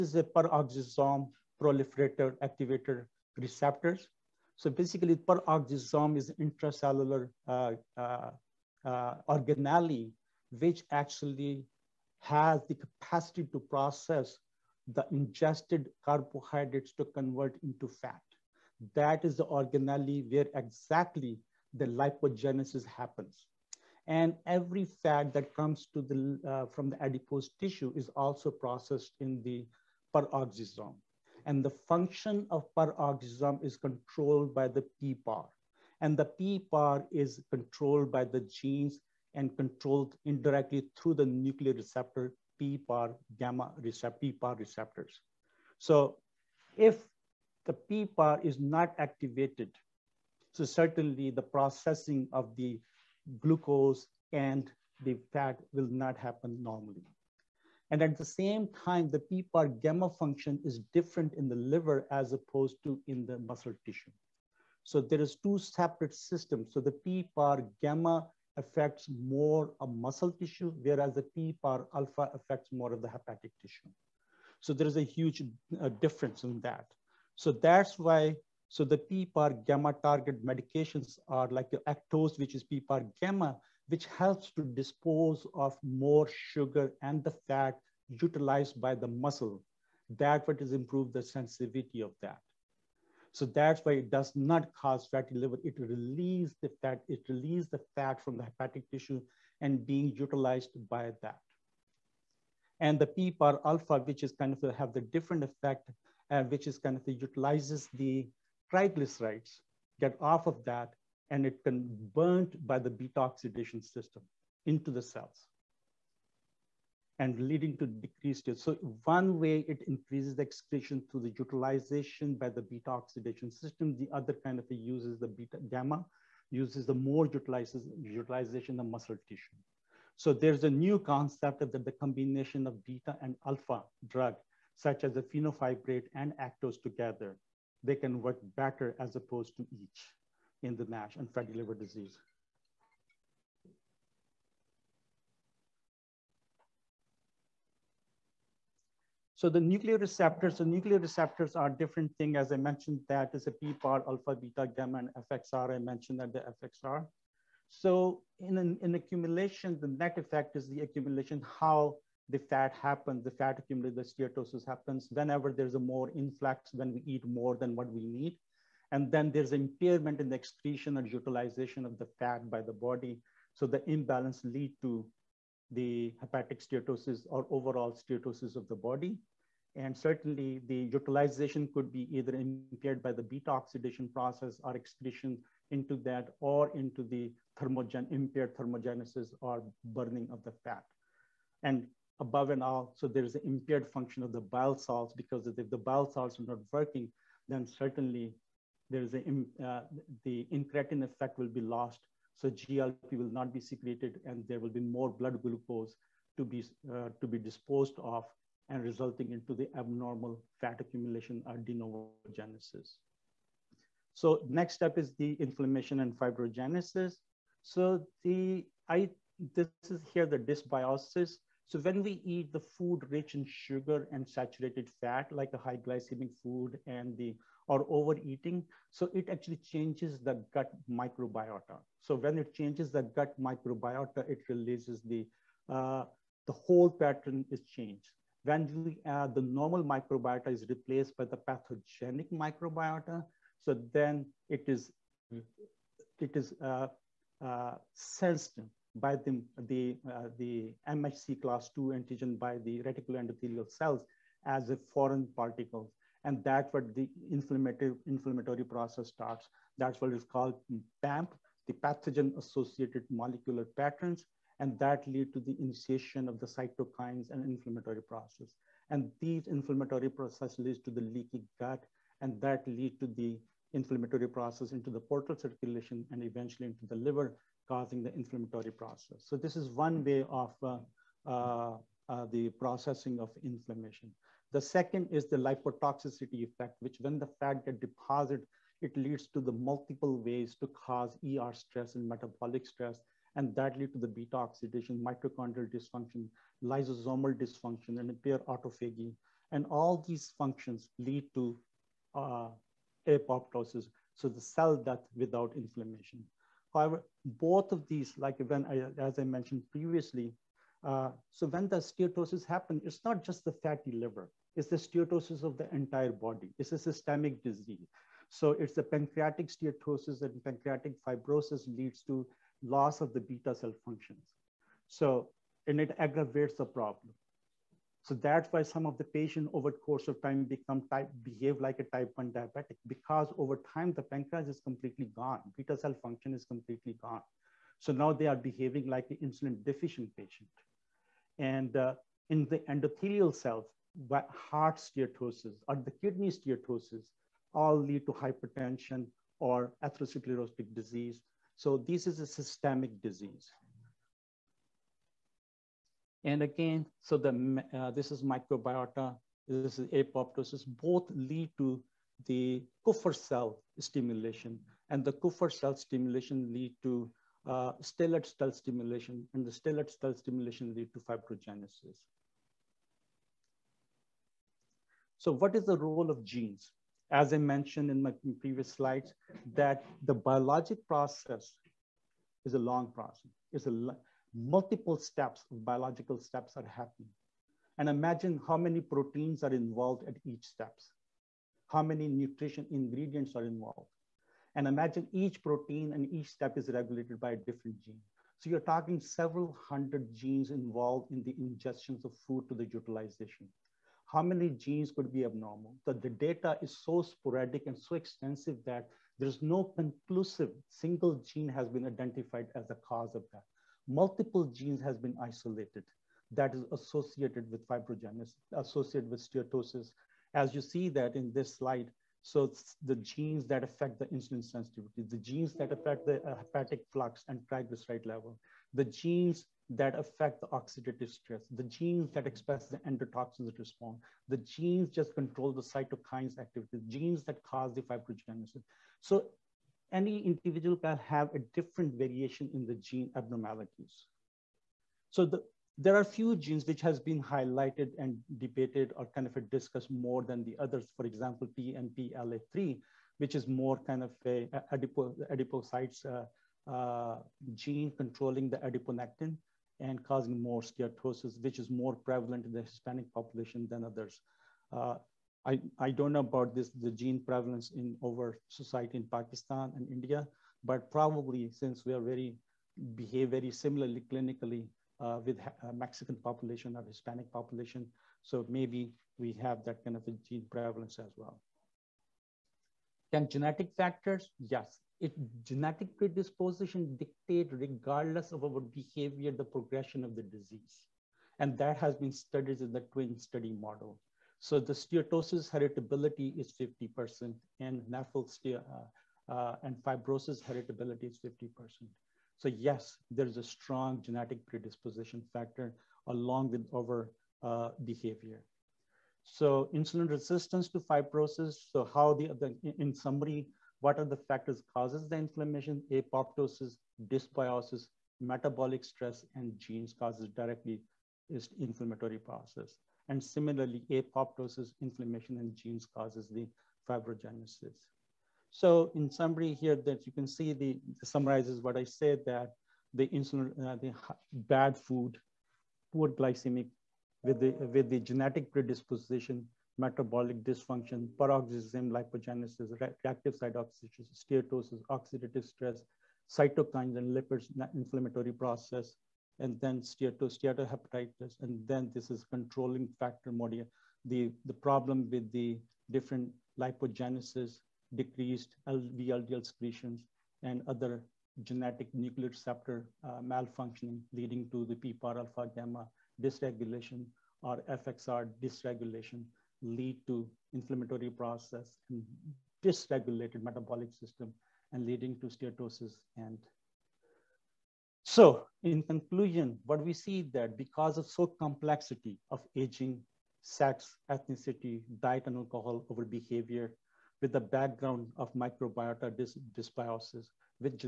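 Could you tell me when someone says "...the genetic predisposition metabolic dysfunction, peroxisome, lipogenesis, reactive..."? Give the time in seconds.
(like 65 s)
537 s.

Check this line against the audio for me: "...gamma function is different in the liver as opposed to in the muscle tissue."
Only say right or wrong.
right.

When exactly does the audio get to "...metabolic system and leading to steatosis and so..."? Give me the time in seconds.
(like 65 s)
573 s.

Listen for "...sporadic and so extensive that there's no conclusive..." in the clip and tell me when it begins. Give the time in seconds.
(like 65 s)
407 s.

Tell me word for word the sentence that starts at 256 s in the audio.
And that's what the inflammatory, inflammatory process starts.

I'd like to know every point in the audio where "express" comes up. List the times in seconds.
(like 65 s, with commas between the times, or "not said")
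432 s.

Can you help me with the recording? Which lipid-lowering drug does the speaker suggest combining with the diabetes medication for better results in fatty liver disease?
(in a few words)
fenofibrate.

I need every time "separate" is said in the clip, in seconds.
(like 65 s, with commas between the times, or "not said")
65 s.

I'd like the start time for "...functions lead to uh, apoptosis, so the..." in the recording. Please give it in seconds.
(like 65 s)
300 s.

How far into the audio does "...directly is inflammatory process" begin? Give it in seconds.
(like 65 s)
520 s.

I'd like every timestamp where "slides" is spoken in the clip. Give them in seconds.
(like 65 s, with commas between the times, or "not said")
378 s, 421 s.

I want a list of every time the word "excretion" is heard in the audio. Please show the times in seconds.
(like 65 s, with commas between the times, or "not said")
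120 s, 170 s, 184 s.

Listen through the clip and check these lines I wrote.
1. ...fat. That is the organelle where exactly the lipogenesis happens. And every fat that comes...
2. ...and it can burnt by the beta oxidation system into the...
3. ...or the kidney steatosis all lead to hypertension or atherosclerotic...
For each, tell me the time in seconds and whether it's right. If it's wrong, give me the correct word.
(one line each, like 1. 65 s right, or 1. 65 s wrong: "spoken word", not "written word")
1. 17 s right
2. 111 s right
3. 345 s right.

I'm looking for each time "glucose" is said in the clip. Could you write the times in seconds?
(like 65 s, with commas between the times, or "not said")
53 s, 205 s.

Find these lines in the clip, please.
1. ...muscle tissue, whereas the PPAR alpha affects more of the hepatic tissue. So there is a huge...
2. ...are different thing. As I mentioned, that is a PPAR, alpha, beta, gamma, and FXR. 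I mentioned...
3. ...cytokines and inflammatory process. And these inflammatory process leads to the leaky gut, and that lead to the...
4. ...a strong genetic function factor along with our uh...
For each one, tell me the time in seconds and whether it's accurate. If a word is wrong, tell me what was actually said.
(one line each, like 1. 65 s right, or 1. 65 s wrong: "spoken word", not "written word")
1. 69 s right
2. 151 s right
3. 266 s right
4. 503 s wrong: "predisposition", not "function".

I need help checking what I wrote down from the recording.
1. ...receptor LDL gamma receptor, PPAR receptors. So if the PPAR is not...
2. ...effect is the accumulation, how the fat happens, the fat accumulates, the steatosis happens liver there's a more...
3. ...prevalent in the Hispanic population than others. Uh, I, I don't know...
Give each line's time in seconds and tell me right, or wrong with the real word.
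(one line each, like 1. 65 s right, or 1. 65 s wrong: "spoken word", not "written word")
1. 41 s wrong: "PPAR", not "LDL"
2. 160 s wrong: "whenever", not "liver"
3. 461 s right.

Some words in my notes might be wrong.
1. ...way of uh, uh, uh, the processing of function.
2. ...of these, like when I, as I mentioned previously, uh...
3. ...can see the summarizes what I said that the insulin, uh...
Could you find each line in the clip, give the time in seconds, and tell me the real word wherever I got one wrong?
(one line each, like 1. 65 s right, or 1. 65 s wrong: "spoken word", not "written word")
1. 280 s wrong: "inflammation", not "function"
2. 307 s right
3. 530 s right.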